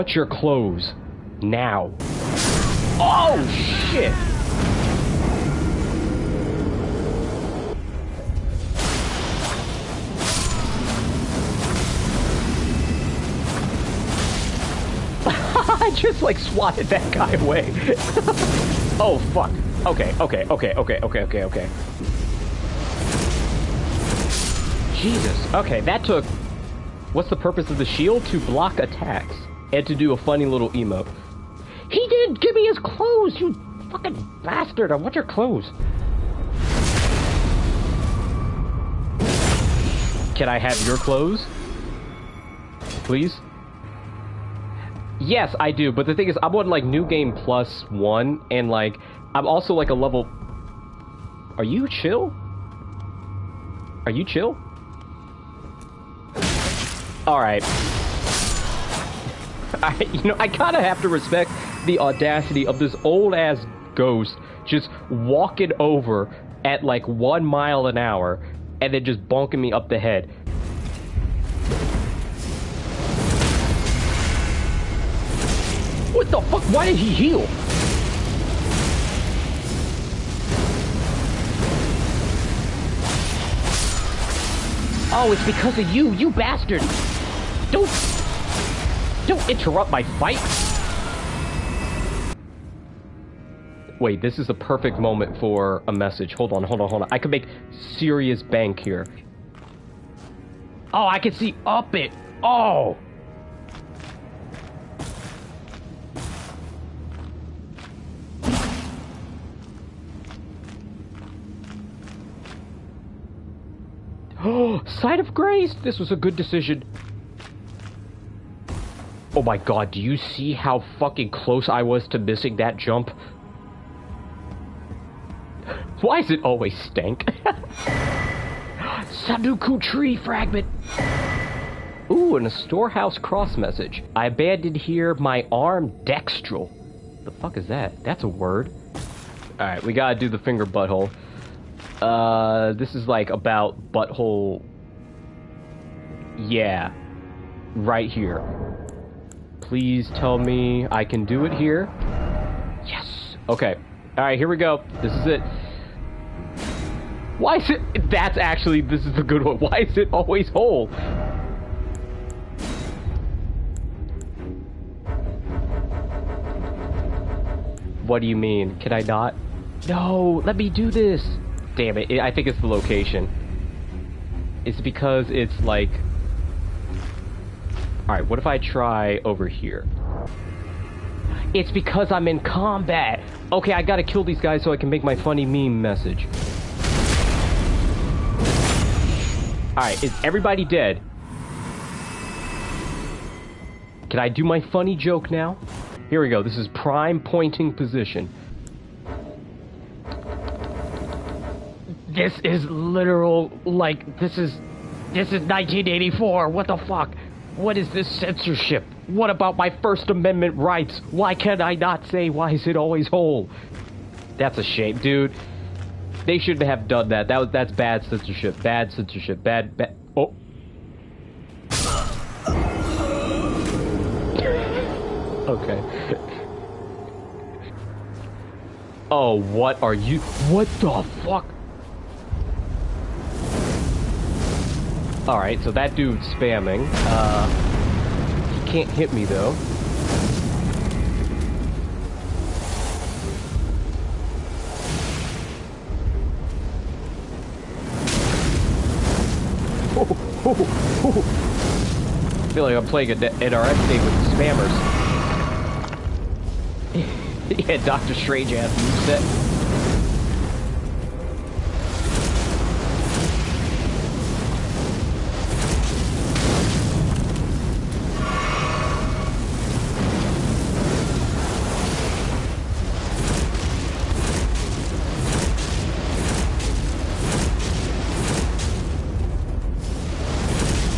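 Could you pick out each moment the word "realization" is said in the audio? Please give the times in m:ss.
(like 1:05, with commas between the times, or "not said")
not said.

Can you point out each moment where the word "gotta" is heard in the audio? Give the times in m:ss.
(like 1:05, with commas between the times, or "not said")
2:19, 3:03.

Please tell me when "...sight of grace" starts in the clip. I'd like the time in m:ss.
1:54.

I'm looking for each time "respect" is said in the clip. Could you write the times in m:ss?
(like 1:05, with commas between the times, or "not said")
1:01.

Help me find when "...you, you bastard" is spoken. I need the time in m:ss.
1:25.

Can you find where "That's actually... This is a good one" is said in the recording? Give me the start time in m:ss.
2:38.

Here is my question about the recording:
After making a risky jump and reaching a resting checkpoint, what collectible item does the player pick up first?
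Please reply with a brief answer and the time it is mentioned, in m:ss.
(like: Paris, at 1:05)
Scadutree fragment, at 2:09.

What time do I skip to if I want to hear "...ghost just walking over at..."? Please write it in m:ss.
1:03.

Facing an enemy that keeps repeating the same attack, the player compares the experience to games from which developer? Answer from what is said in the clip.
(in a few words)
NRS.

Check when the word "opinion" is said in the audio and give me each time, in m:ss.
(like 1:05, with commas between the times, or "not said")
not said.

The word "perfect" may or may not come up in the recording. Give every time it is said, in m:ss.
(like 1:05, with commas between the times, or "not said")
1:34.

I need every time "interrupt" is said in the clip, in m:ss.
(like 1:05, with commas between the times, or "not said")
1:29.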